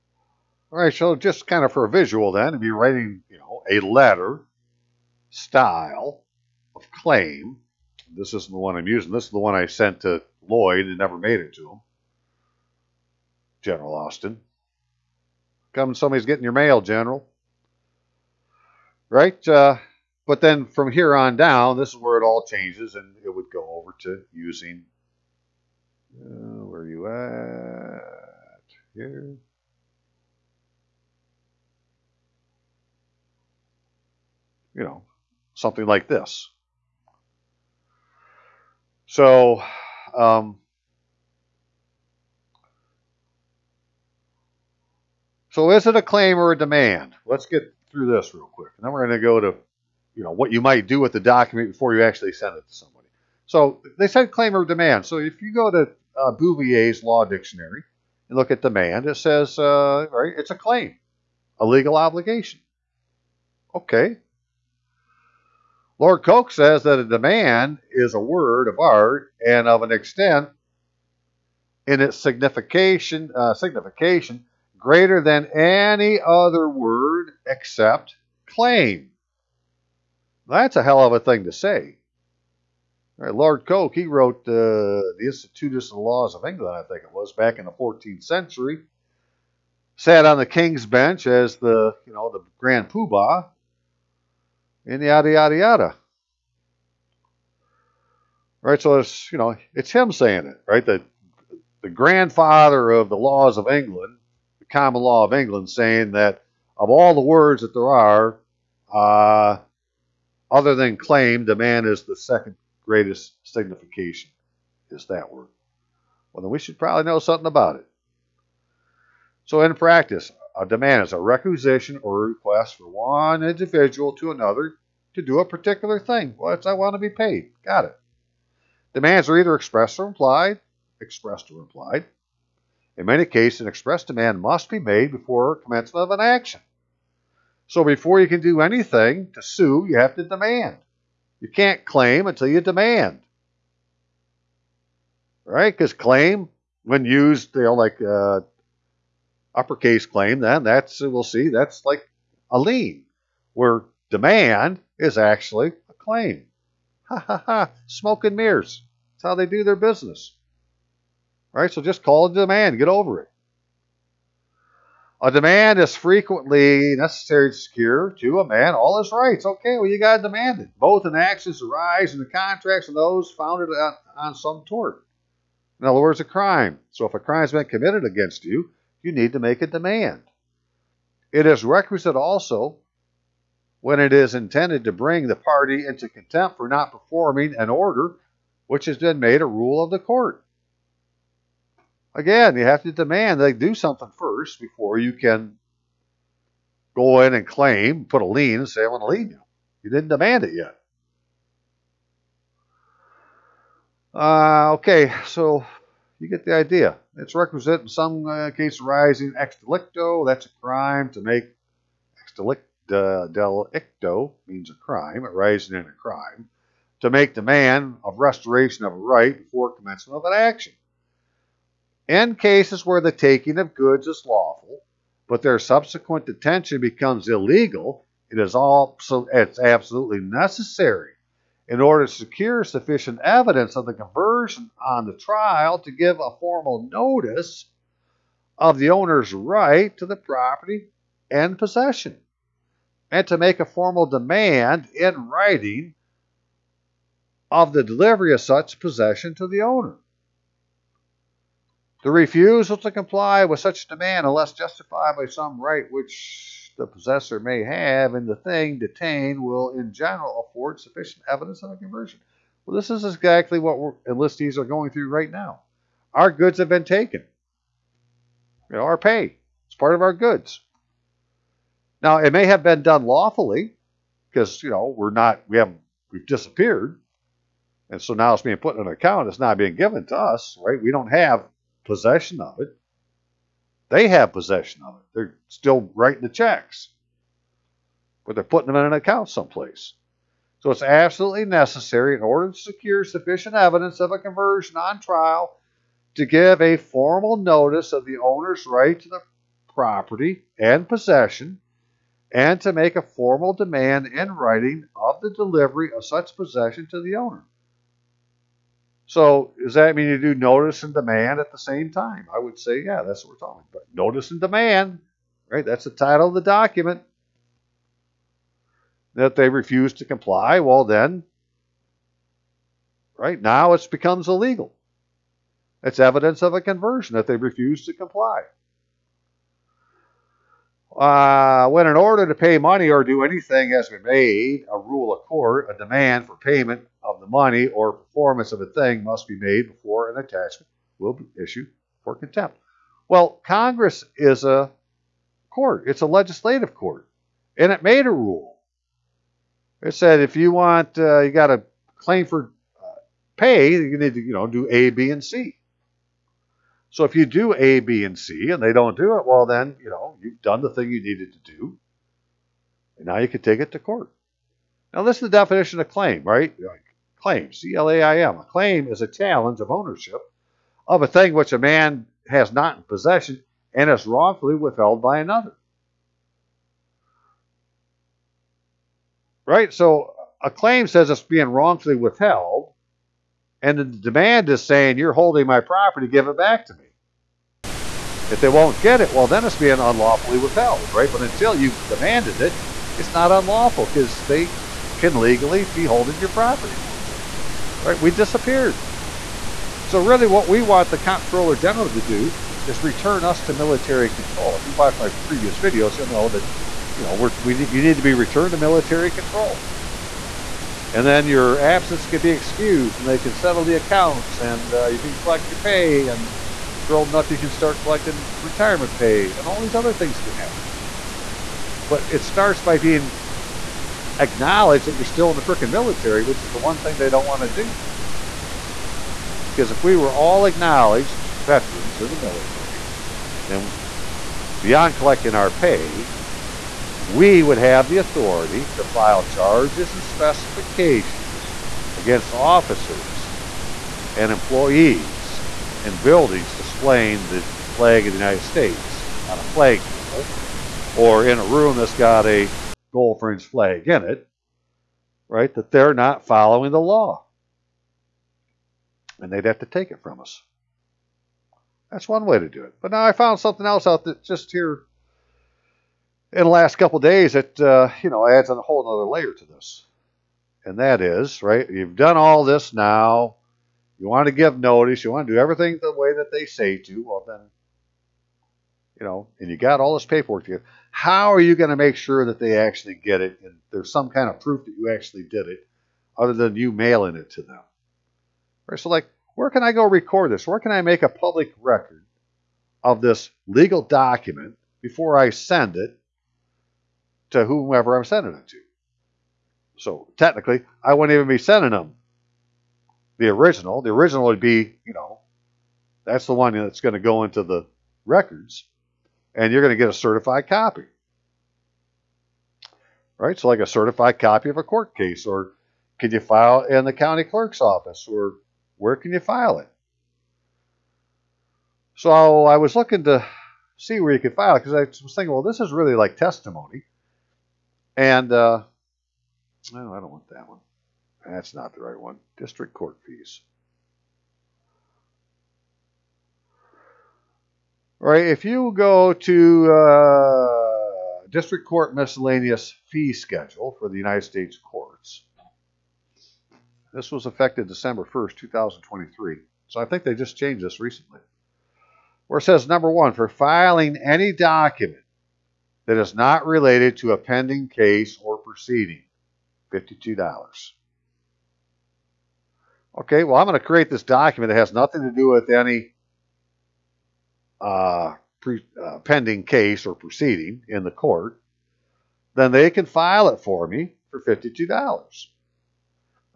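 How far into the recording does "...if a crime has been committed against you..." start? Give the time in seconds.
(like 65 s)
177 s.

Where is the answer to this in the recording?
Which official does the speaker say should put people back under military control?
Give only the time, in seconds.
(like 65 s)
400 s.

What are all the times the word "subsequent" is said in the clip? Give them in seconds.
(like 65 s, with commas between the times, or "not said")
225 s.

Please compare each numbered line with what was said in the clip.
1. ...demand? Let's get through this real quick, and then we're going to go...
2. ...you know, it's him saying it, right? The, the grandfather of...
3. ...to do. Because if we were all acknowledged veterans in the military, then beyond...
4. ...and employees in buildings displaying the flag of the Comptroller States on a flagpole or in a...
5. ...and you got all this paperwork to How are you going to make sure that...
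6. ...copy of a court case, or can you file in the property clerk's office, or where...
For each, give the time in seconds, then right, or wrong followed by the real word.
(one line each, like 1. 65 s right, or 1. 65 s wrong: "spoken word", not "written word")
1. 46 s right
2. 99 s right
3. 427 s right
4. 444 s wrong: "United", not "Comptroller"
5. 479 s right
6. 514 s wrong: "county", not "property".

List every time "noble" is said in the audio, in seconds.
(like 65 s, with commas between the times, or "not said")
not said.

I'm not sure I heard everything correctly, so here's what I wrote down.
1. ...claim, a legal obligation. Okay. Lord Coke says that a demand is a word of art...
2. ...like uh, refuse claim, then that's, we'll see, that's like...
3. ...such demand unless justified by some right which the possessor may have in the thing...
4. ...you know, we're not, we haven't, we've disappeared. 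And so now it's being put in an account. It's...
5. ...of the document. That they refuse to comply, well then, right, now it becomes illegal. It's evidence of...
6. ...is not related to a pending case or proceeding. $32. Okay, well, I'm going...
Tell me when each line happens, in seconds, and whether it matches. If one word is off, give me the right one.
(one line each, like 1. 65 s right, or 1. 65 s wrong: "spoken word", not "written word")
1. 60 s right
2. 147 s wrong: "uppercase", not "refuse"
3. 253 s right
4. 274 s right
5. 316 s right
6. 556 s wrong: "52", not "32".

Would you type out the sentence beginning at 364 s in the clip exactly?
Now, this is the definition of claim, right?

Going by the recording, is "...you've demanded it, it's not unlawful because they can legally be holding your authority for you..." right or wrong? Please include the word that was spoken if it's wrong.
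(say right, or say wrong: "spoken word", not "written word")
wrong: "property", not "authority".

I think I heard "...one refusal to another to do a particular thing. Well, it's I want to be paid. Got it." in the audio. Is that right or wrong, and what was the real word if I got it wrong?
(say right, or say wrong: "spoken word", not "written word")
wrong: "individual", not "refusal".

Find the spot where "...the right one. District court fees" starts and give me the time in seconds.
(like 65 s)
531 s.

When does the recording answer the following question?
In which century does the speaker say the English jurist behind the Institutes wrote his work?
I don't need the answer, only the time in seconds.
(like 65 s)
87 s.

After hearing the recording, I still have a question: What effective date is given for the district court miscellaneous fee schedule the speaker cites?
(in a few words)
December 1st, 2023.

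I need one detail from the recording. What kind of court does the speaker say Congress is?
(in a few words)
legislative court.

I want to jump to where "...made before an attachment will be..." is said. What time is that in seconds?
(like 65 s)
339 s.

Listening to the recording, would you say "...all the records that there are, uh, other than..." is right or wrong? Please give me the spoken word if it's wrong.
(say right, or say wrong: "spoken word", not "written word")
wrong: "words", not "records".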